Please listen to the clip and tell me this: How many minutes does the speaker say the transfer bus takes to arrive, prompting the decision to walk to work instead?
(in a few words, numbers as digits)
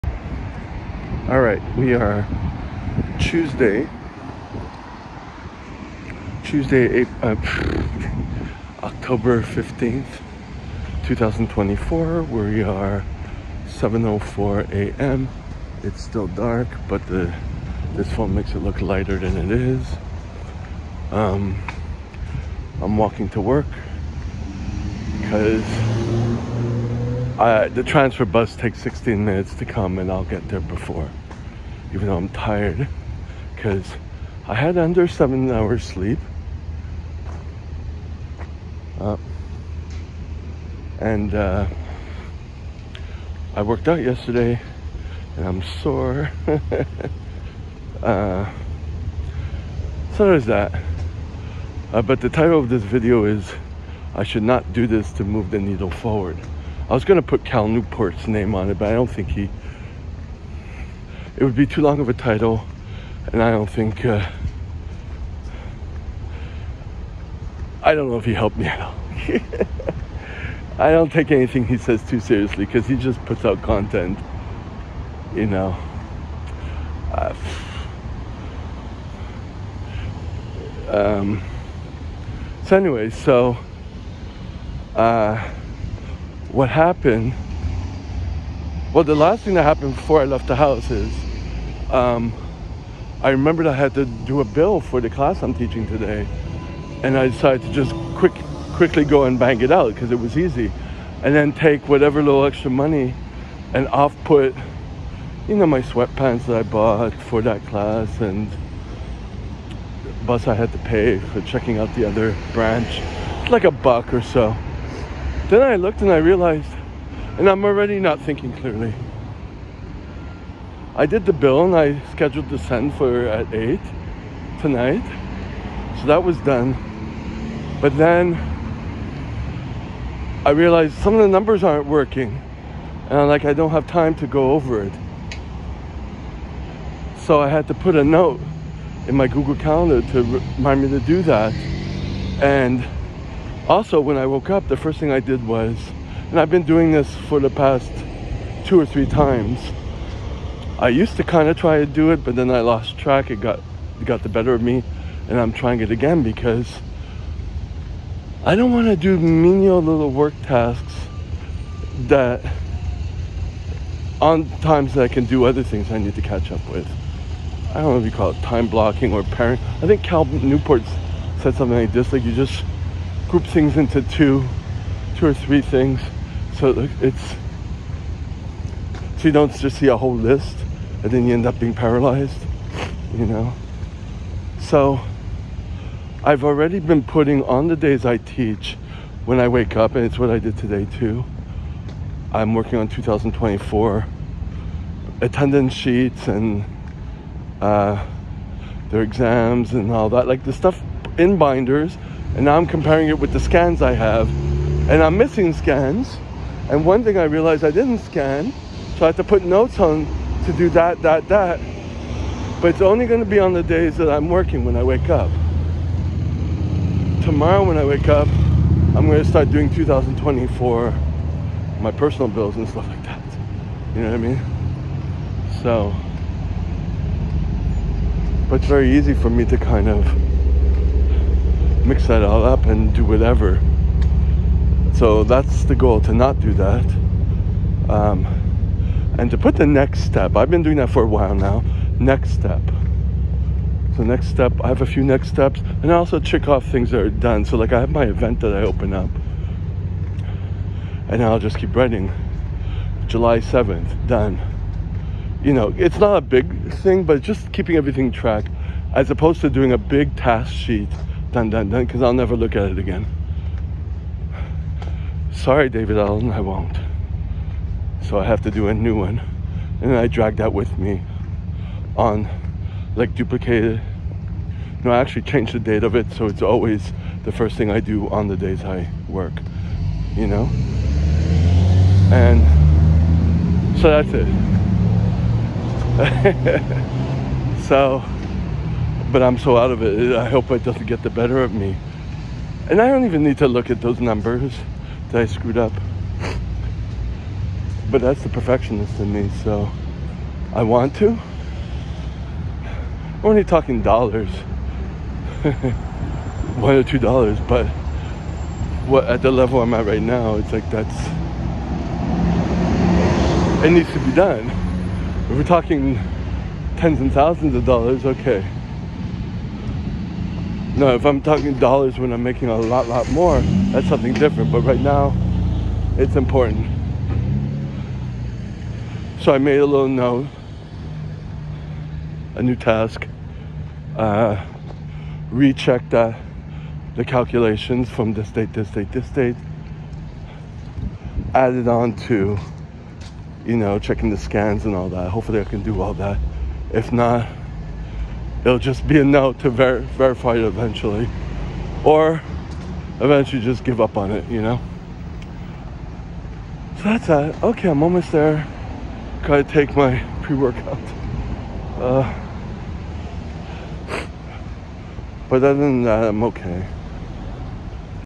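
16.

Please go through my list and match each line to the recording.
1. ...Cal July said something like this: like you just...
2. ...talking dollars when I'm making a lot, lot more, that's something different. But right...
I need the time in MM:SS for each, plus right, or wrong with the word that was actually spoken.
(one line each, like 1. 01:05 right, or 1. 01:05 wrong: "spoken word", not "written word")
1. 02:50 wrong: "Newport", not "July"
2. 05:21 right.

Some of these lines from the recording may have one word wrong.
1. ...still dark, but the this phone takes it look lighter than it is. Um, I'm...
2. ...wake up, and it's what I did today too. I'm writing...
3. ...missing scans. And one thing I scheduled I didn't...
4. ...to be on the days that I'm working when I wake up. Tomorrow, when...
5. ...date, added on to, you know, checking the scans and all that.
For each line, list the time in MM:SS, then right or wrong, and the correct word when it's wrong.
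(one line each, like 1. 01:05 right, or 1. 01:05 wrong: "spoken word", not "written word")
1. 00:16 wrong: "makes", not "takes"
2. 03:09 wrong: "working", not "writing"
3. 03:25 wrong: "realized", not "scheduled"
4. 03:33 right
5. 05:39 right.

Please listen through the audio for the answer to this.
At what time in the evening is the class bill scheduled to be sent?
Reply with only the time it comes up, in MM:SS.
02:03.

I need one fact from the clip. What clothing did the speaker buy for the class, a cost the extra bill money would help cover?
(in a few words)
Sweatpants.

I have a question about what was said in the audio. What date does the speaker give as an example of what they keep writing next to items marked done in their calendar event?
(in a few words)
July 7th.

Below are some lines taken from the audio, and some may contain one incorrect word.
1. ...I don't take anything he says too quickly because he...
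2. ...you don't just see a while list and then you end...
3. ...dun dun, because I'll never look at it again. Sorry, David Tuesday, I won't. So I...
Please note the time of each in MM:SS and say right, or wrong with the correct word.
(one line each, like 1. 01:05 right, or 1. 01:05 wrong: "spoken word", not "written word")
1. 01:10 wrong: "seriously", not "quickly"
2. 02:59 wrong: "whole", not "while"
3. 04:21 wrong: "Allen", not "Tuesday".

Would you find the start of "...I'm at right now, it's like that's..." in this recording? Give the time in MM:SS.
05:09.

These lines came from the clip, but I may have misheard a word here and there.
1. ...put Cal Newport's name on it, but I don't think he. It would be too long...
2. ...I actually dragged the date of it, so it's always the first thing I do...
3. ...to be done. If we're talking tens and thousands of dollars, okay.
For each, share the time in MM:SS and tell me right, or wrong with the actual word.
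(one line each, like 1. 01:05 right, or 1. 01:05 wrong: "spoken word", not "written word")
1. 00:57 right
2. 04:34 wrong: "changed", not "dragged"
3. 05:13 right.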